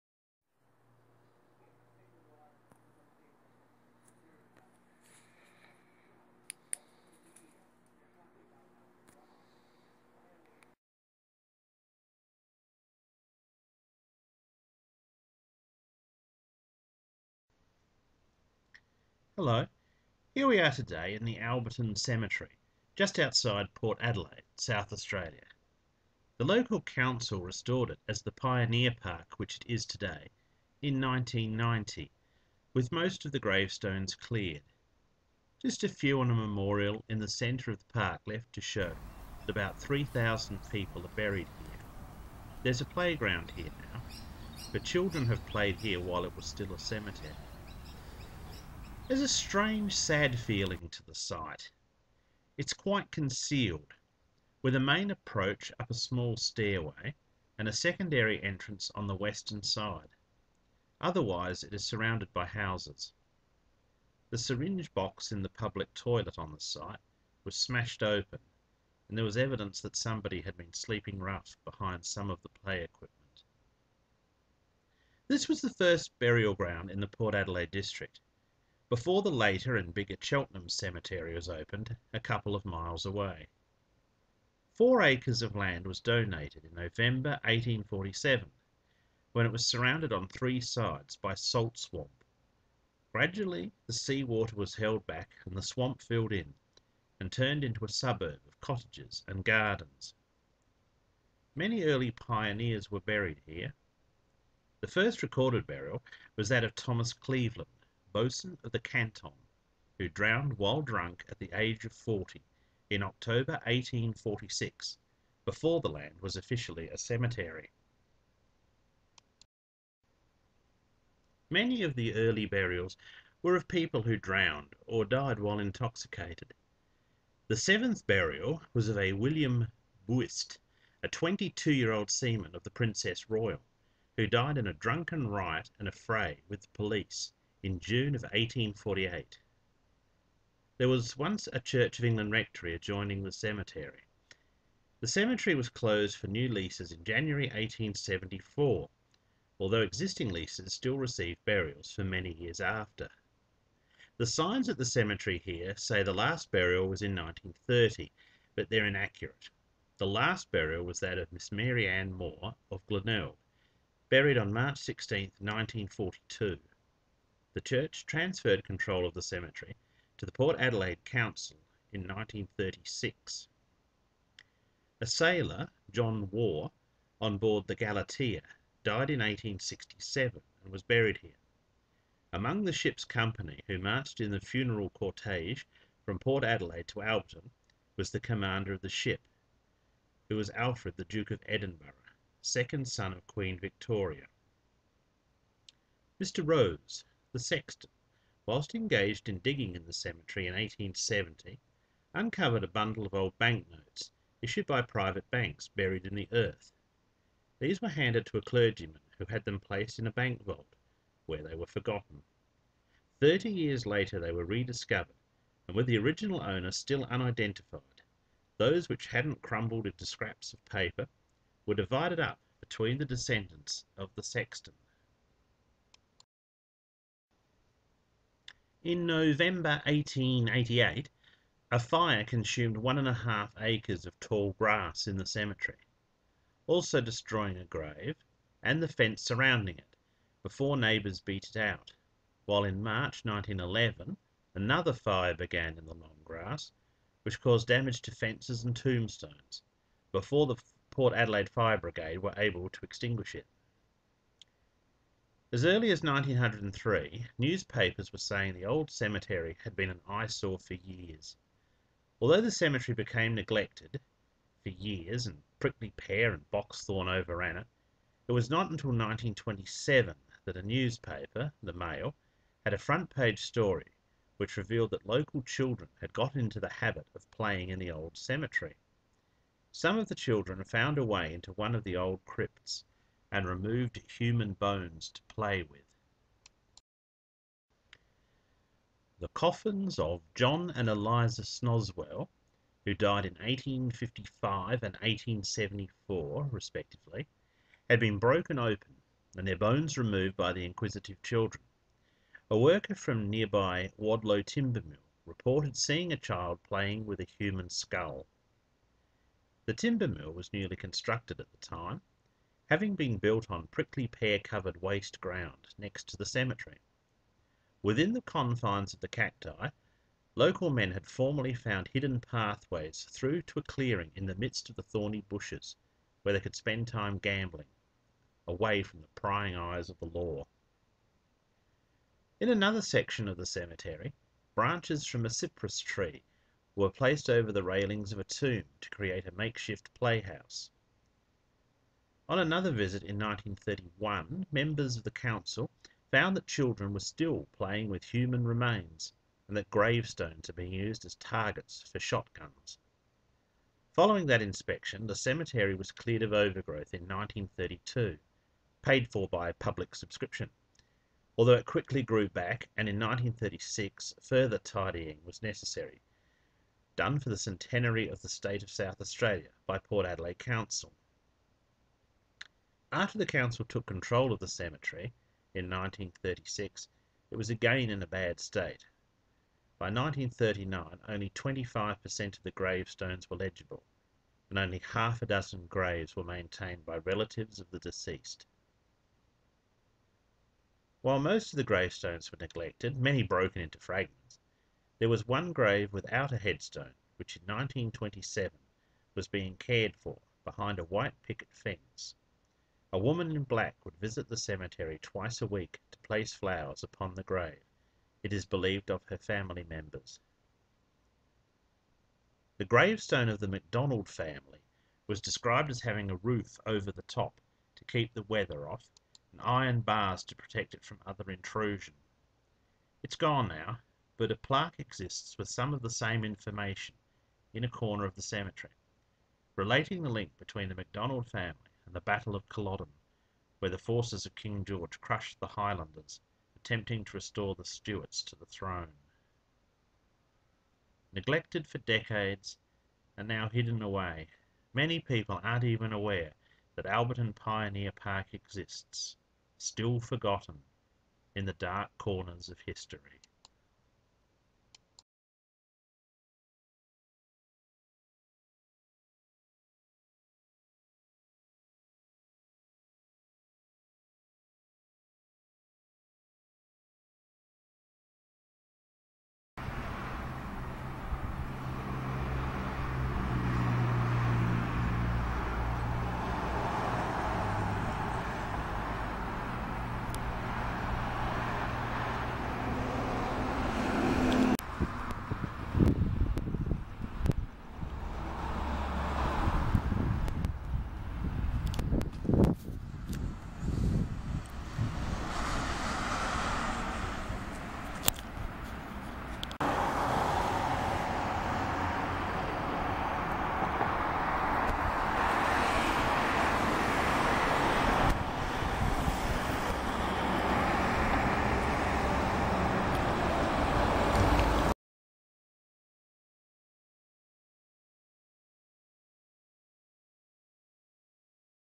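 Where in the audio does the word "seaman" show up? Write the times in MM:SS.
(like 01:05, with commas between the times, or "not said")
02:12.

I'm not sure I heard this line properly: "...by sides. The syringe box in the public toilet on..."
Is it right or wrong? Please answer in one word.
wrong.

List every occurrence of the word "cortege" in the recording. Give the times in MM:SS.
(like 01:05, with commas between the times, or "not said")
03:04.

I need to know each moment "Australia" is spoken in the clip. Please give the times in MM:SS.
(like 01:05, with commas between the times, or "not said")
00:24, 06:09.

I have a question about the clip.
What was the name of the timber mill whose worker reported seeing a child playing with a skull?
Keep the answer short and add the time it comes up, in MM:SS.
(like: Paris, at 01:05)
Wadlow Timber Mill, at 05:03.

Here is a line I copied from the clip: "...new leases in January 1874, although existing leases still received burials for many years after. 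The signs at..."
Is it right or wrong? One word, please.
right.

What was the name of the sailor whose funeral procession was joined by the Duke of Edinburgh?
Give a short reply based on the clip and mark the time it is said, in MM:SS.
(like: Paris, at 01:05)
John Waugh, at 02:55.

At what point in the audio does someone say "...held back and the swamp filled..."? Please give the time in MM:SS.
01:34.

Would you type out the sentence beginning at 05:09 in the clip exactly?
The timber mill was newly constructed at the time, having been built on prickly pear-covered waste ground next to the cemetery.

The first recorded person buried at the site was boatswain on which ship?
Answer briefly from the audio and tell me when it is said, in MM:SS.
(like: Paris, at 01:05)
Canton, at 01:48.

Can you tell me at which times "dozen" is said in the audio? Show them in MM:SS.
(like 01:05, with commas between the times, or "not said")
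06:25.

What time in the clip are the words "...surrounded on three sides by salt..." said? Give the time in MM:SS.
01:29.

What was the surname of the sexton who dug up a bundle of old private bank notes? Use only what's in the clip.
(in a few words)
Rose.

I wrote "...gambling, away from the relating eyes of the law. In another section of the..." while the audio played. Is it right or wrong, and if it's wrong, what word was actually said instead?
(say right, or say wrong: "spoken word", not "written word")
wrong: "prying", not "relating".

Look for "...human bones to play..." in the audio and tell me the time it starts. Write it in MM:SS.
04:44.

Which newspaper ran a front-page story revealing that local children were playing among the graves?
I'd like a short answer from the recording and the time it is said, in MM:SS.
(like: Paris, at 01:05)
The Mail, at 04:31.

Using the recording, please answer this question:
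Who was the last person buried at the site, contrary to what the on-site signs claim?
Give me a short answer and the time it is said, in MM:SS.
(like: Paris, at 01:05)
Mary Ann Moore, at 02:41.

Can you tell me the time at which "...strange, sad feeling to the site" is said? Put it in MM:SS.
00:49.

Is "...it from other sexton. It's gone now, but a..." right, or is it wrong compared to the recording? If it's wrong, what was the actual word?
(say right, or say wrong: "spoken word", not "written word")
wrong: "intrusion", not "sexton".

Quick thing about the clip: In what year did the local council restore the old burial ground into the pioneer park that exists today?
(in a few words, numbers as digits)
1990.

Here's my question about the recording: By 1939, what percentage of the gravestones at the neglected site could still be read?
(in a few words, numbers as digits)
25%.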